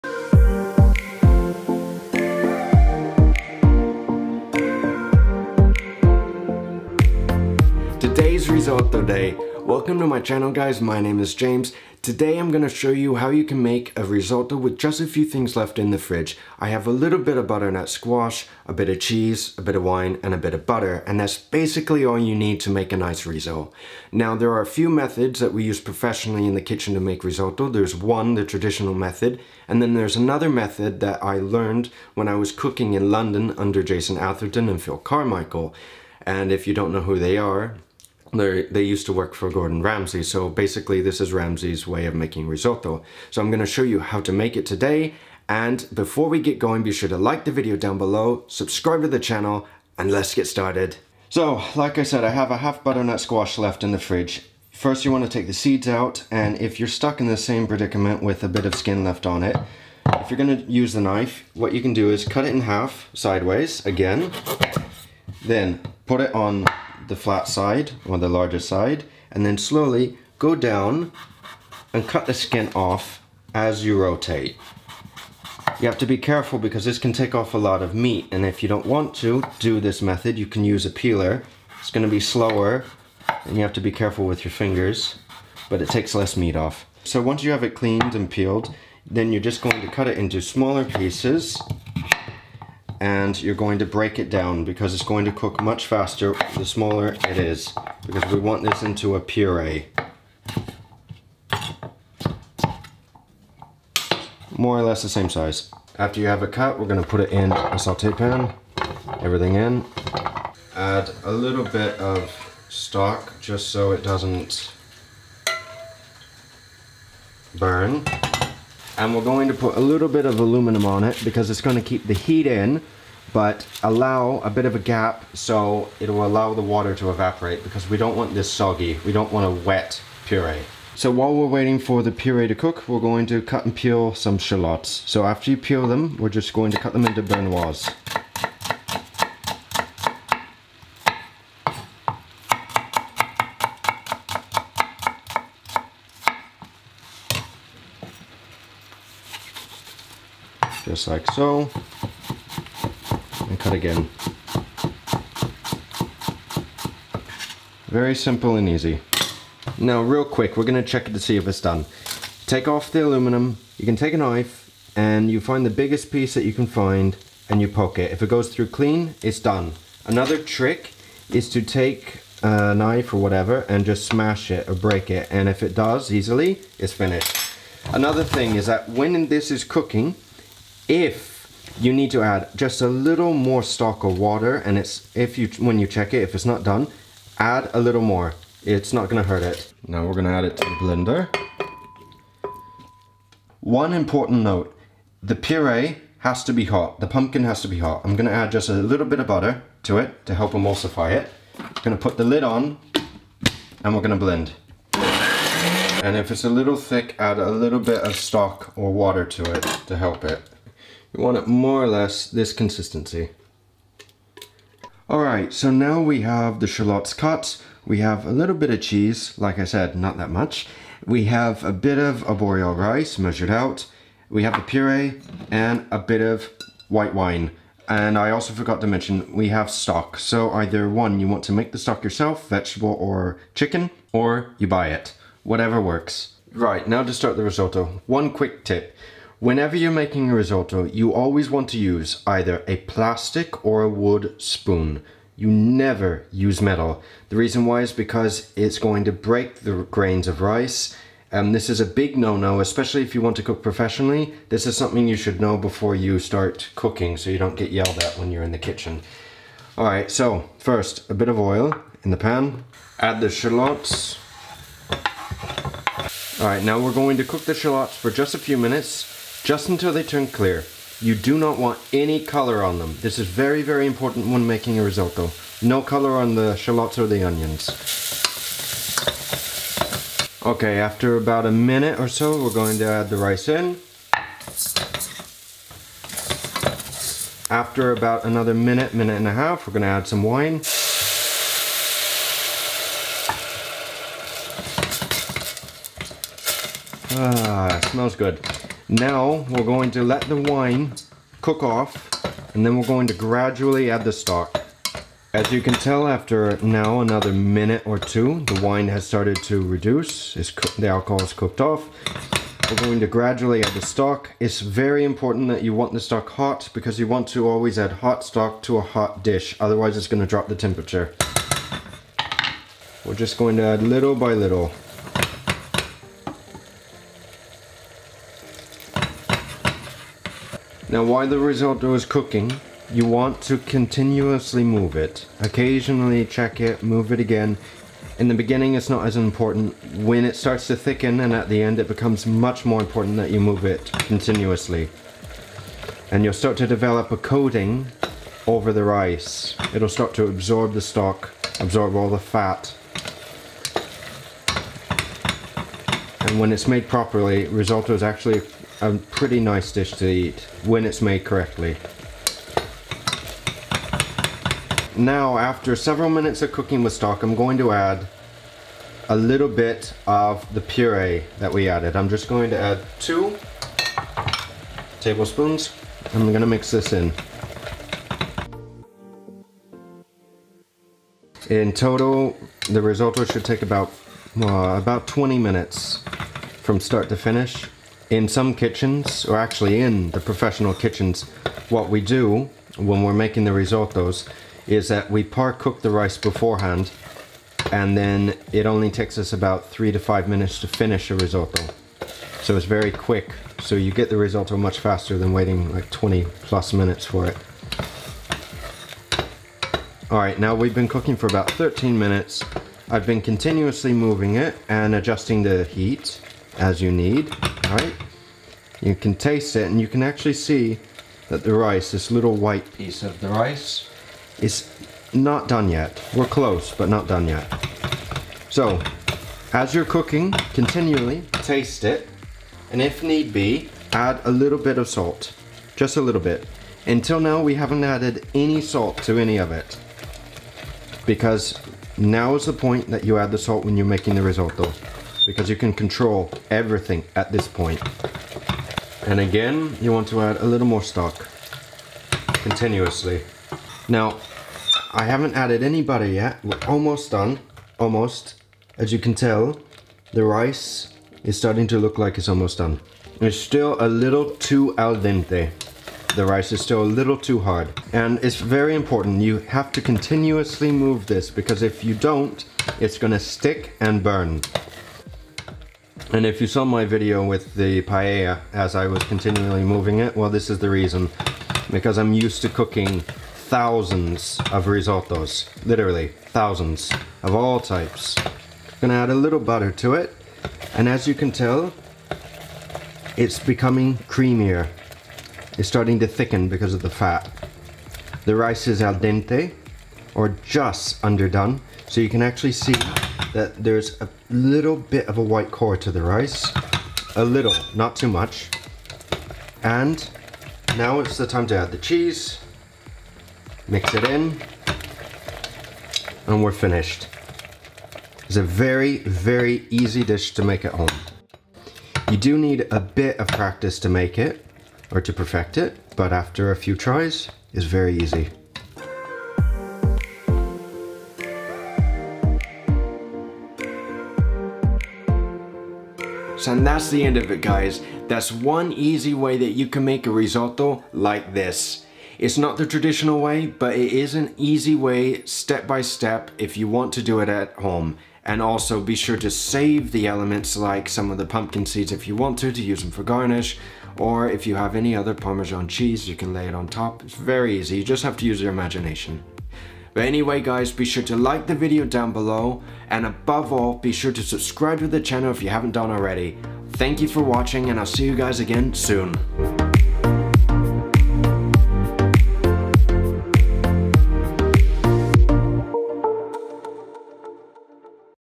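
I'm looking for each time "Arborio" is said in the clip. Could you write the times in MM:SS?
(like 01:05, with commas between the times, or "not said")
03:42.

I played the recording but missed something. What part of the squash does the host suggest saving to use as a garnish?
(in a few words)
Pumpkin seeds.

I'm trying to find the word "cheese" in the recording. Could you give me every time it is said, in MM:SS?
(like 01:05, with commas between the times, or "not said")
00:18, 03:38, 08:31, 09:15.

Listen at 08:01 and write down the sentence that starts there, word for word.
Because I'm used to cooking thousands of risottos, literally thousands of all types.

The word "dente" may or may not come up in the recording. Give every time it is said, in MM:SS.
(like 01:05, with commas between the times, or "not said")
07:44, 08:18.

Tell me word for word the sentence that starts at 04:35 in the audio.
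No color on the shallots or the onions.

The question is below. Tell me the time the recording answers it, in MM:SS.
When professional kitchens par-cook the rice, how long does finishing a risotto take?
06:39.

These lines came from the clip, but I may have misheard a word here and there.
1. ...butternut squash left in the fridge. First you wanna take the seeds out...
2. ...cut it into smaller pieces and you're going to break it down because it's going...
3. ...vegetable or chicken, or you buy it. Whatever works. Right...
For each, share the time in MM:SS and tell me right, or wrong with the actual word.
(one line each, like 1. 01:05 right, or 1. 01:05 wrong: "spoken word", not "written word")
1. 00:52 right
2. 01:29 right
3. 03:52 right.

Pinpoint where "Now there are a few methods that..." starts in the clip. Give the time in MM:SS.
00:24.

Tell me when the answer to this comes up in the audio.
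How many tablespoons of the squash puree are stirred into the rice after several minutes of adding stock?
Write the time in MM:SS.
06:12.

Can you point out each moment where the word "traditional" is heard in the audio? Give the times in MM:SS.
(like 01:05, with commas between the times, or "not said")
00:28, 09:02.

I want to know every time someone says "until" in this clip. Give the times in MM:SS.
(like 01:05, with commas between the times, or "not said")
04:29, 07:16.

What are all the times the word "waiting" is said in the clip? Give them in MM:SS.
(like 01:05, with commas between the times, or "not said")
02:11, 06:45.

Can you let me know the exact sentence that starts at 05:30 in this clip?
Now while the risotto is cooking, you want to continuously move it.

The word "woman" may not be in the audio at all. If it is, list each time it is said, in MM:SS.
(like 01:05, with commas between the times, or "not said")
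not said.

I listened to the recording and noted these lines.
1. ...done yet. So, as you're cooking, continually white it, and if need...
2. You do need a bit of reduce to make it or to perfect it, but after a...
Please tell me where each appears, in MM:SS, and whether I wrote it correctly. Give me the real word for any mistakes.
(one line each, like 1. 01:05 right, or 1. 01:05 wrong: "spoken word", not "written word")
1. 07:07 wrong: "taste", not "white"
2. 08:42 wrong: "practice", not "reduce".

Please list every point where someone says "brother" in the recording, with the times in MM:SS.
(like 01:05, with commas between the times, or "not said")
not said.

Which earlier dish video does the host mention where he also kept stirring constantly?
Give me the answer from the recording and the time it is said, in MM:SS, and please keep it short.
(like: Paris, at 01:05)
Paella, at 07:57.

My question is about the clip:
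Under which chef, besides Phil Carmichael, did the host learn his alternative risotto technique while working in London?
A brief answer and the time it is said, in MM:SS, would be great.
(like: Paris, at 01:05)
Jason Atherton, at 00:33.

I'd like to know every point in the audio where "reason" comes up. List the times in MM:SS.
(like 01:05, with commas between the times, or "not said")
04:07, 08:00.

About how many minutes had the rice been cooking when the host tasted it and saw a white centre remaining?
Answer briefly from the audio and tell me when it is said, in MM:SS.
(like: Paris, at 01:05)
13, at 06:51.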